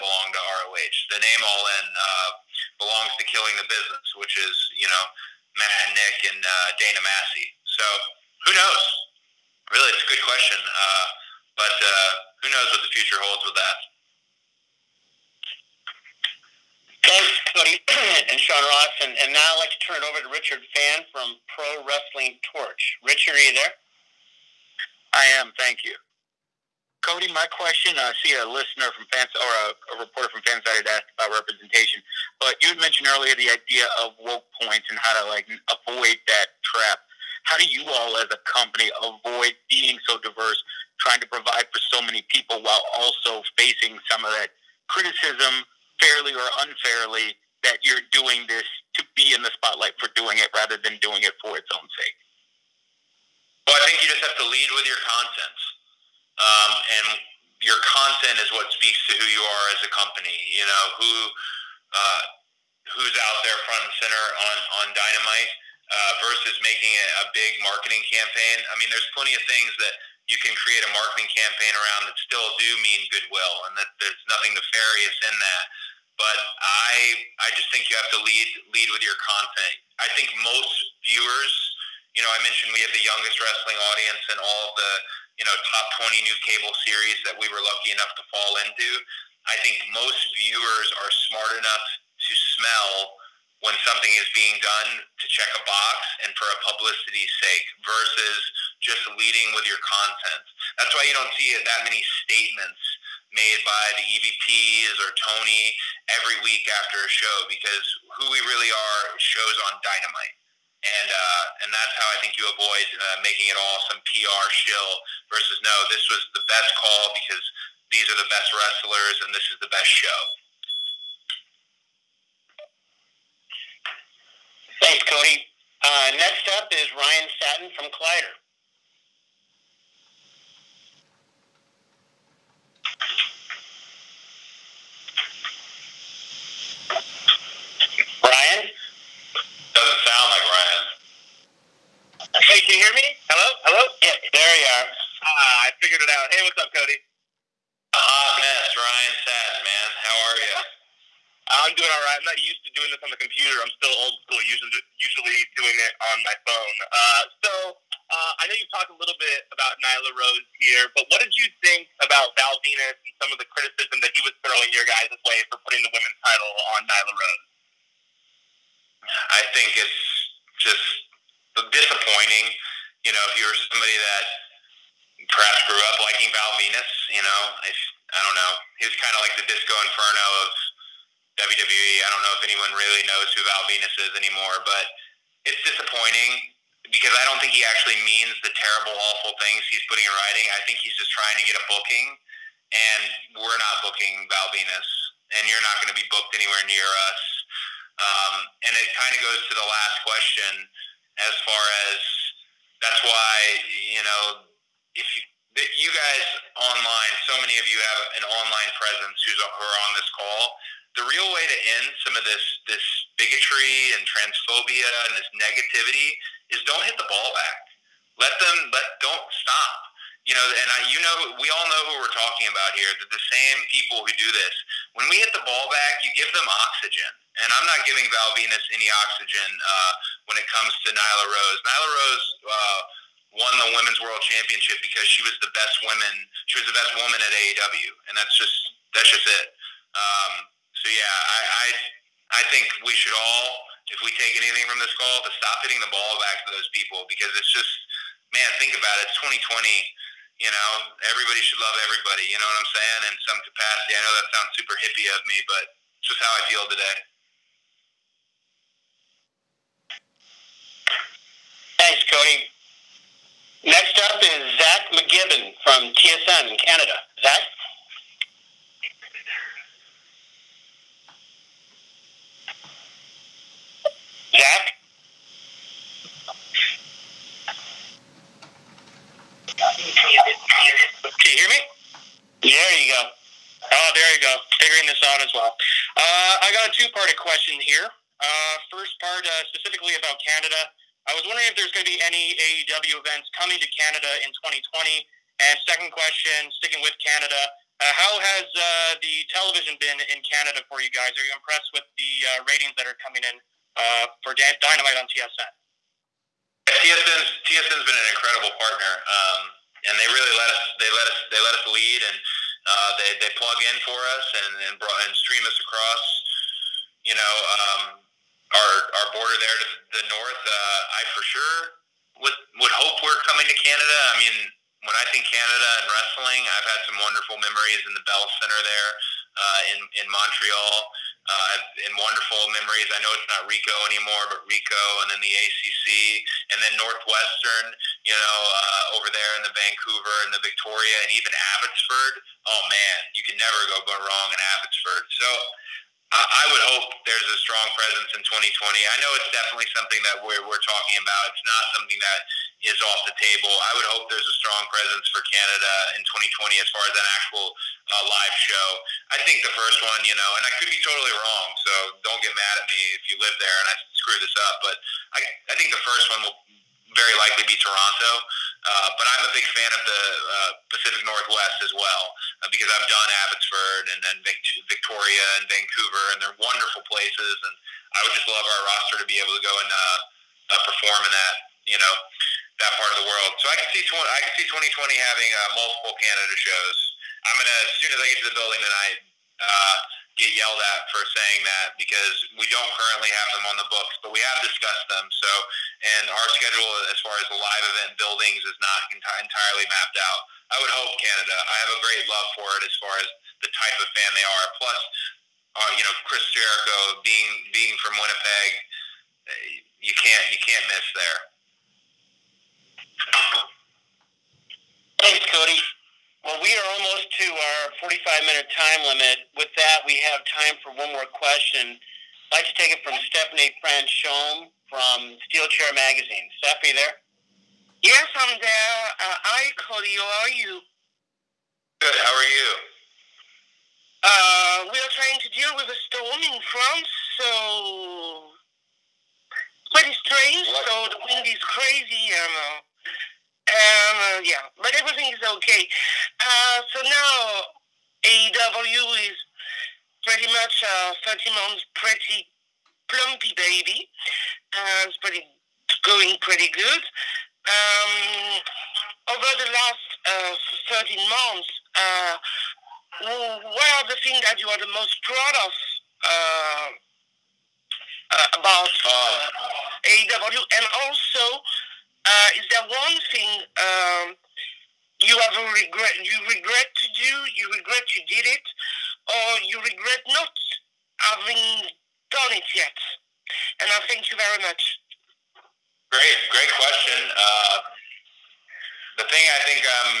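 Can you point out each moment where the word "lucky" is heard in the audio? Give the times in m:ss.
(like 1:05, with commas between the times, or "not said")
1:27.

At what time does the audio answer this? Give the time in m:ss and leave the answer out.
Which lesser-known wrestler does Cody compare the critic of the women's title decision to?
2:59.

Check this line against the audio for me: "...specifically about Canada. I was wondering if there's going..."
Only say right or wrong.
right.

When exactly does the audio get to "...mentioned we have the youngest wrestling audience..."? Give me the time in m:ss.
1:22.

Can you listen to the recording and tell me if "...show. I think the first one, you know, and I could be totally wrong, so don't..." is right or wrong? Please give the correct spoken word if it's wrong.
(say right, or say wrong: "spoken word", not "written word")
right.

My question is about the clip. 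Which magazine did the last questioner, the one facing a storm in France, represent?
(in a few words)
Steel Chair Magazine.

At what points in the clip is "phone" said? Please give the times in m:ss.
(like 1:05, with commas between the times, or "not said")
2:36.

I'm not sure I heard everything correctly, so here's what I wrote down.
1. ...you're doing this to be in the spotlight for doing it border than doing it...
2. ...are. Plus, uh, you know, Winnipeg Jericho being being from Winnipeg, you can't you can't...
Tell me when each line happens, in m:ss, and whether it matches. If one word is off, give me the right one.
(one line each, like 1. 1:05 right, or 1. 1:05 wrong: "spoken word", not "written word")
1. 0:47 wrong: "rather", not "border"
2. 6:44 wrong: "Chris", not "Winnipeg".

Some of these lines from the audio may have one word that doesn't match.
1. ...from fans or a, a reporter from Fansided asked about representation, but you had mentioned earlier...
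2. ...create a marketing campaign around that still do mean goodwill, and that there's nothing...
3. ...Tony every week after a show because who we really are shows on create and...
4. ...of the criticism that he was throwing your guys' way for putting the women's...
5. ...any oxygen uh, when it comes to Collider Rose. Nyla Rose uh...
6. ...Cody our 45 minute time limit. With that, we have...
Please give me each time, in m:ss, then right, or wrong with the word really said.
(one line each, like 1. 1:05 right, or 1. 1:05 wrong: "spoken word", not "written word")
1. 0:28 right
2. 1:10 right
3. 1:45 wrong: "dynamite", not "create"
4. 2:43 right
5. 3:48 wrong: "Nyla", not "Collider"
6. 6:55 right.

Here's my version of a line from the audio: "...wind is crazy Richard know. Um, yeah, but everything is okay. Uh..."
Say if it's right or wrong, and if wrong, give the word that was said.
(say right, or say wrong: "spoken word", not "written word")
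wrong: "You", not "Richard".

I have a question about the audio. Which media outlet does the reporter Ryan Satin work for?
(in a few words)
Collider.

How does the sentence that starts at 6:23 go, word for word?
So I can see tw- I can see 2020 having uh, multiple Canada shows.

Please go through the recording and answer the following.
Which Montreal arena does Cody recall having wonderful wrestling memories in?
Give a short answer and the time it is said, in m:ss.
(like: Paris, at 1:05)
Bell Center, at 5:28.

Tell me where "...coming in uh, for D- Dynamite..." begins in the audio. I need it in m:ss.
5:02.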